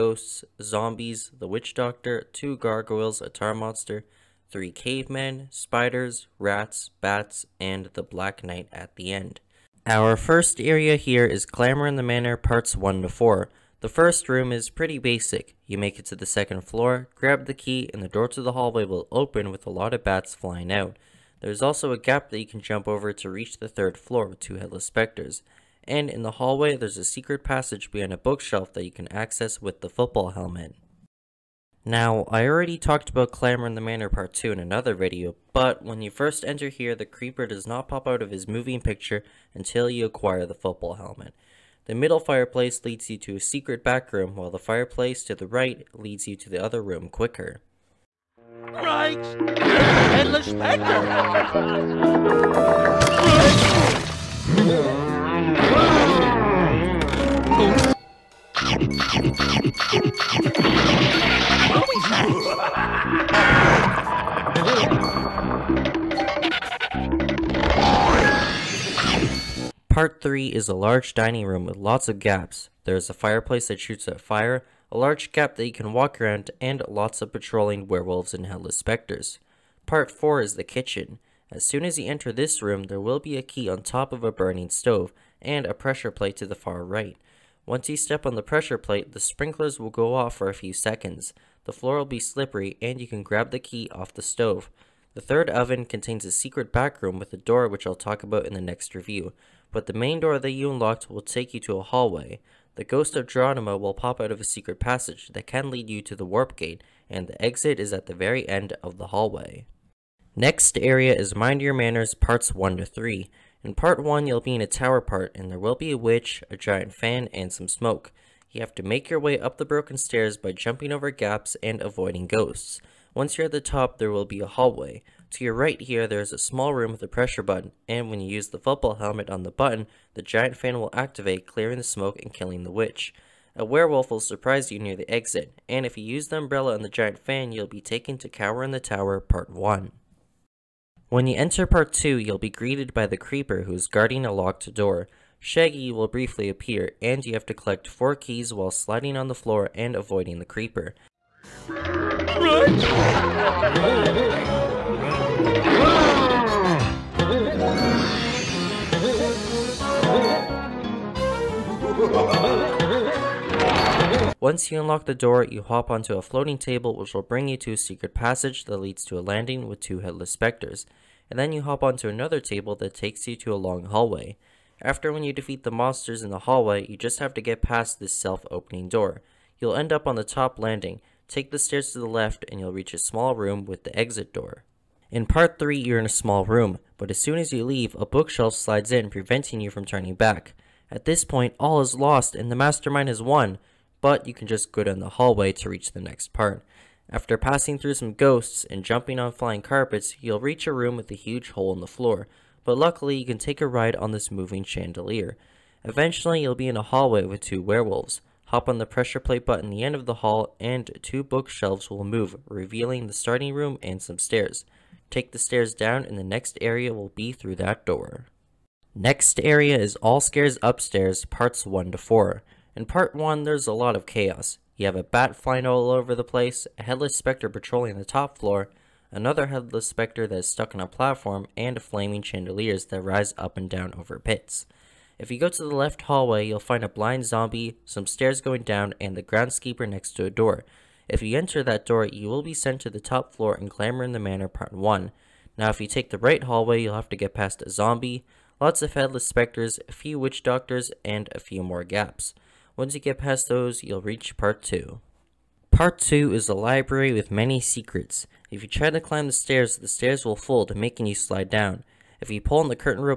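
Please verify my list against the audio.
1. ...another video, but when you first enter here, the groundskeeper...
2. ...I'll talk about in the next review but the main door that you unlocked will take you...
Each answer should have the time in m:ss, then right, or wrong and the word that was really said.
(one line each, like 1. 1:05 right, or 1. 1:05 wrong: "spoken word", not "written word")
1. 0:34 wrong: "creeper", not "groundskeeper"
2. 1:37 right.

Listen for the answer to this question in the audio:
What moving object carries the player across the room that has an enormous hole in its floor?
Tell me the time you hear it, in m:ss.
3:24.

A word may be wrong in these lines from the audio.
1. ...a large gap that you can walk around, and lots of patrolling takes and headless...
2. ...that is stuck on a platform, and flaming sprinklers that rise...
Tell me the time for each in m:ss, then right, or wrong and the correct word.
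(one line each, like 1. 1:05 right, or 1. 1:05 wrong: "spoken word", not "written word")
1. 1:14 wrong: "werewolves", not "takes"
2. 3:50 wrong: "chandeliers", not "sprinklers".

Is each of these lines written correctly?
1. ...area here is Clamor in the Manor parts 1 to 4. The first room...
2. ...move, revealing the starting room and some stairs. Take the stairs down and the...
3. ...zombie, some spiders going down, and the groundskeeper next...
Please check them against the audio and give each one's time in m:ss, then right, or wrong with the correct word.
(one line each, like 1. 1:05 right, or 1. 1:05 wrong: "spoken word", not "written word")
1. 0:10 right
2. 3:32 right
3. 3:57 wrong: "stairs", not "spiders".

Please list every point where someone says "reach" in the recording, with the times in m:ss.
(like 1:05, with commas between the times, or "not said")
0:23, 3:02, 3:15, 3:20, 4:14.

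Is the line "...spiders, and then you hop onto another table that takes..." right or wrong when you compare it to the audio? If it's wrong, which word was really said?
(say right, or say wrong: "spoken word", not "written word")
wrong: "specters", not "spiders".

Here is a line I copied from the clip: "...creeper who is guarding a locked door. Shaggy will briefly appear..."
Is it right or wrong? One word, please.
right.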